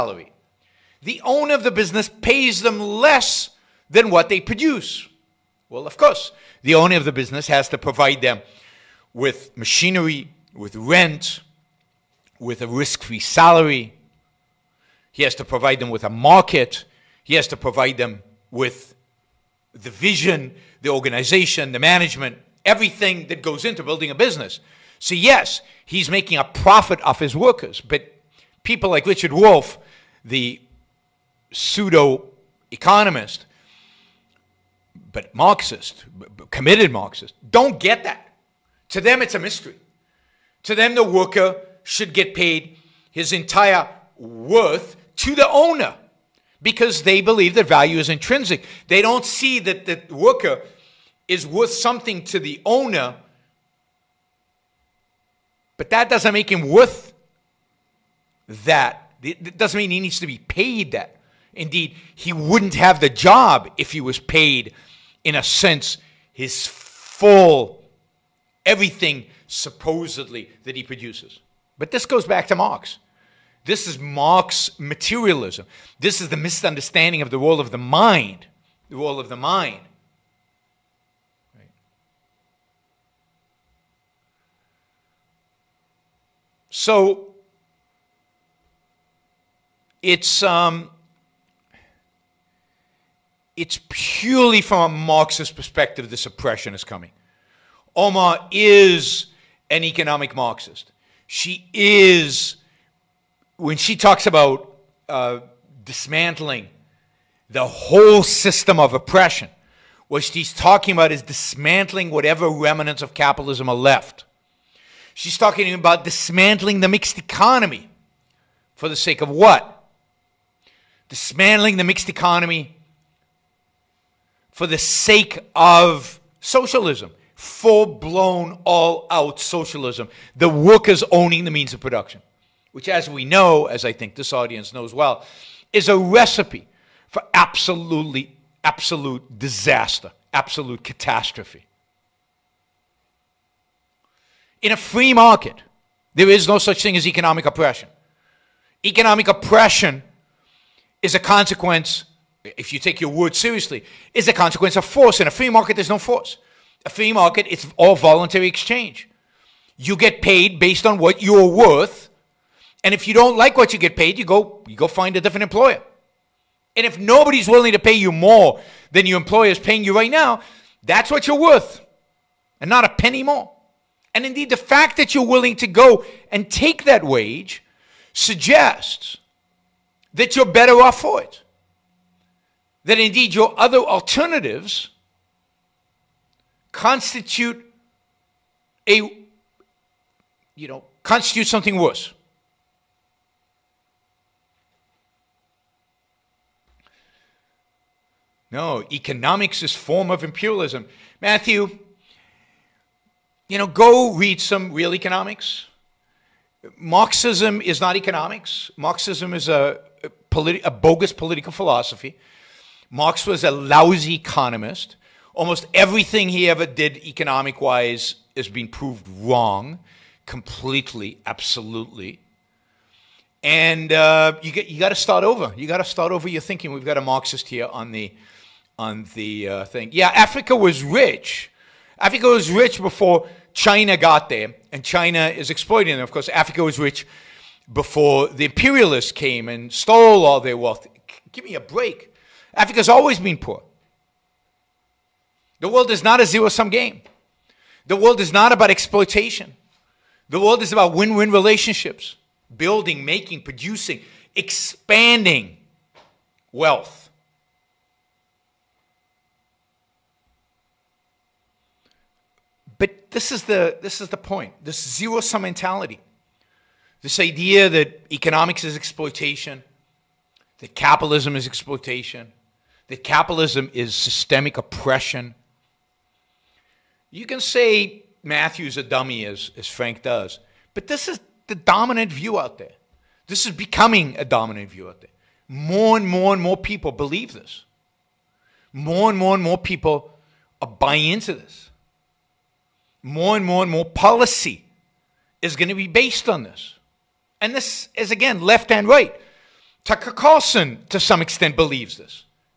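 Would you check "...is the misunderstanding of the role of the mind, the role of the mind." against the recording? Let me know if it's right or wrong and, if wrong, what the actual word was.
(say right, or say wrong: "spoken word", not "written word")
right.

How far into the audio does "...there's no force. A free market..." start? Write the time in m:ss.
2:35.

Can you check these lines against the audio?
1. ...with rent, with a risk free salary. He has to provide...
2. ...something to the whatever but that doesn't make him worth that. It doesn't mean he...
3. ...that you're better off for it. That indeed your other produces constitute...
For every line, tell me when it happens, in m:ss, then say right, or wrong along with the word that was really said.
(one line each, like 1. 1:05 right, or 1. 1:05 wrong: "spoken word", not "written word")
1. 0:10 right
2. 0:51 wrong: "owner", not "whatever"
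3. 3:00 wrong: "alternatives", not "produces".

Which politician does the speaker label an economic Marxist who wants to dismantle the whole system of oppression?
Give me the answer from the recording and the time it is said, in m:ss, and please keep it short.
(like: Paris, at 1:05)
Omar, at 1:37.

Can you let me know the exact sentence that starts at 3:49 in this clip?
Yeah, Africa was rich Africa was rich before China got there, and China is exploiting it.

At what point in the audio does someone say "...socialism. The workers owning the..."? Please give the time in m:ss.
2:09.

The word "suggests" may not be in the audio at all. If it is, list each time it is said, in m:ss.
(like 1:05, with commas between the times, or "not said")
2:58.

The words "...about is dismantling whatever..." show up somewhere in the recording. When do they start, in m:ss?
1:50.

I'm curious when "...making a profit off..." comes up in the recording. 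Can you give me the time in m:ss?
0:26.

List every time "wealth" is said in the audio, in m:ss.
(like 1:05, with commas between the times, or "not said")
4:00, 4:16.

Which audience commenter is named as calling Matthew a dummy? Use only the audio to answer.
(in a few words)
Frank.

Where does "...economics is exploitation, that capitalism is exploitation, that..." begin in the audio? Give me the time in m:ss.
4:28.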